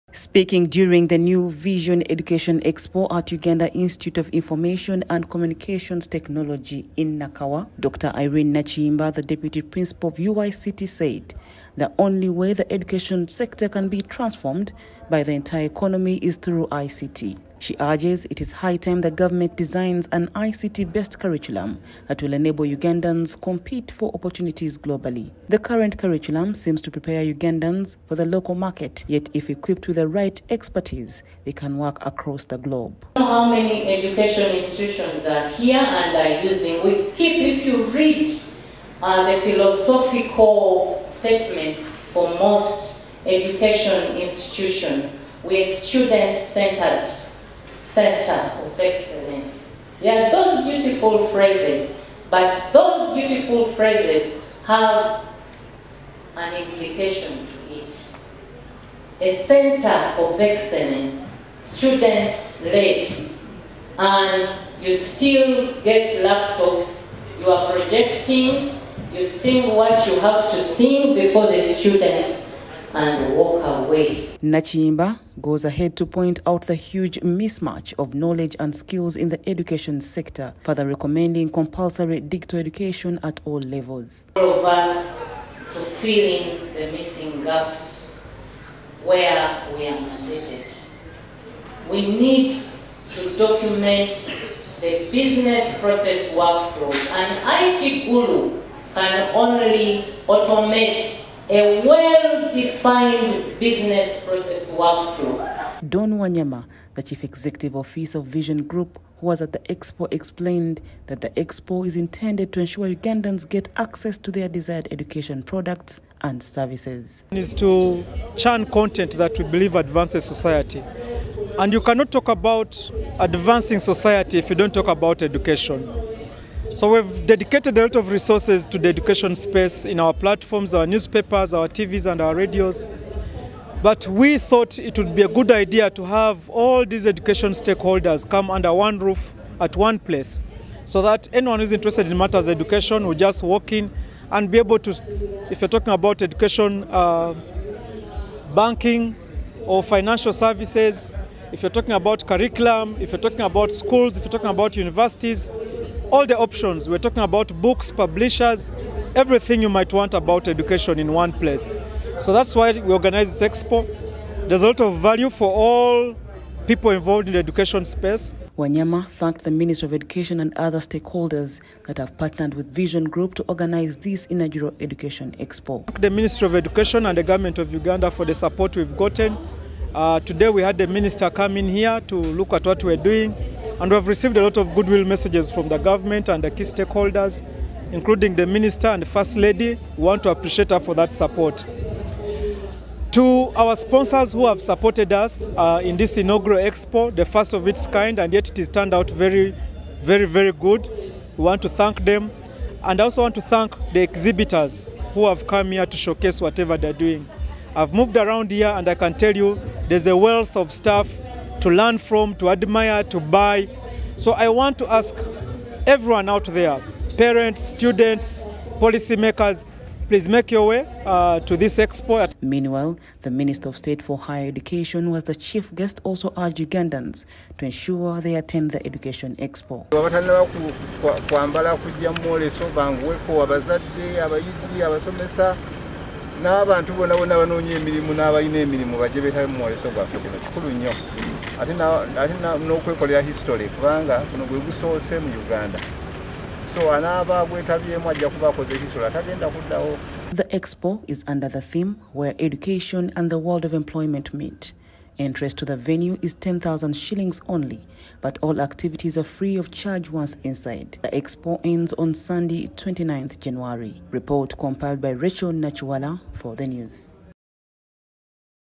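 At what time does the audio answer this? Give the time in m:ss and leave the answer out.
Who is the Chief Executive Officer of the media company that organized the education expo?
1:45.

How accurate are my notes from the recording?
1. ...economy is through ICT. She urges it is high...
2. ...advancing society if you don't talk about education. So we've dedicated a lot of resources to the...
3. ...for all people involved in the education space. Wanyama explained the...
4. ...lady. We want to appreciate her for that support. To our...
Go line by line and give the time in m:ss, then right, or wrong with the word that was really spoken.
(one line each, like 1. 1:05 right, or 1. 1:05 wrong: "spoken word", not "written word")
1. 0:15 right
2. 2:03 right
3. 2:45 wrong: "thanked", not "explained"
4. 3:09 right.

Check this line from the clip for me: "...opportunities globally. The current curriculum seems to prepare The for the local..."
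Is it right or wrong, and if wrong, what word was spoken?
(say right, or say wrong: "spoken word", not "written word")
wrong: "Ugandans", not "The".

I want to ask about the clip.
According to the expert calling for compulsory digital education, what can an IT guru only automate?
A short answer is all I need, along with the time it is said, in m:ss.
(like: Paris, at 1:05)
A well-defined business process workflow, at 1:41.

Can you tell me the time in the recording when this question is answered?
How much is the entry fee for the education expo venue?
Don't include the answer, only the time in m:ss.
4:16.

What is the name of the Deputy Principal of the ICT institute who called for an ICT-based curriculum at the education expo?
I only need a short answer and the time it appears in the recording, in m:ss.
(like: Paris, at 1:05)
Irene Nachimba, at 0:08.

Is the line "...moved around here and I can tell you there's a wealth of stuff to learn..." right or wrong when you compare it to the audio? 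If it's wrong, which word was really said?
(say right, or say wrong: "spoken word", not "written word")
right.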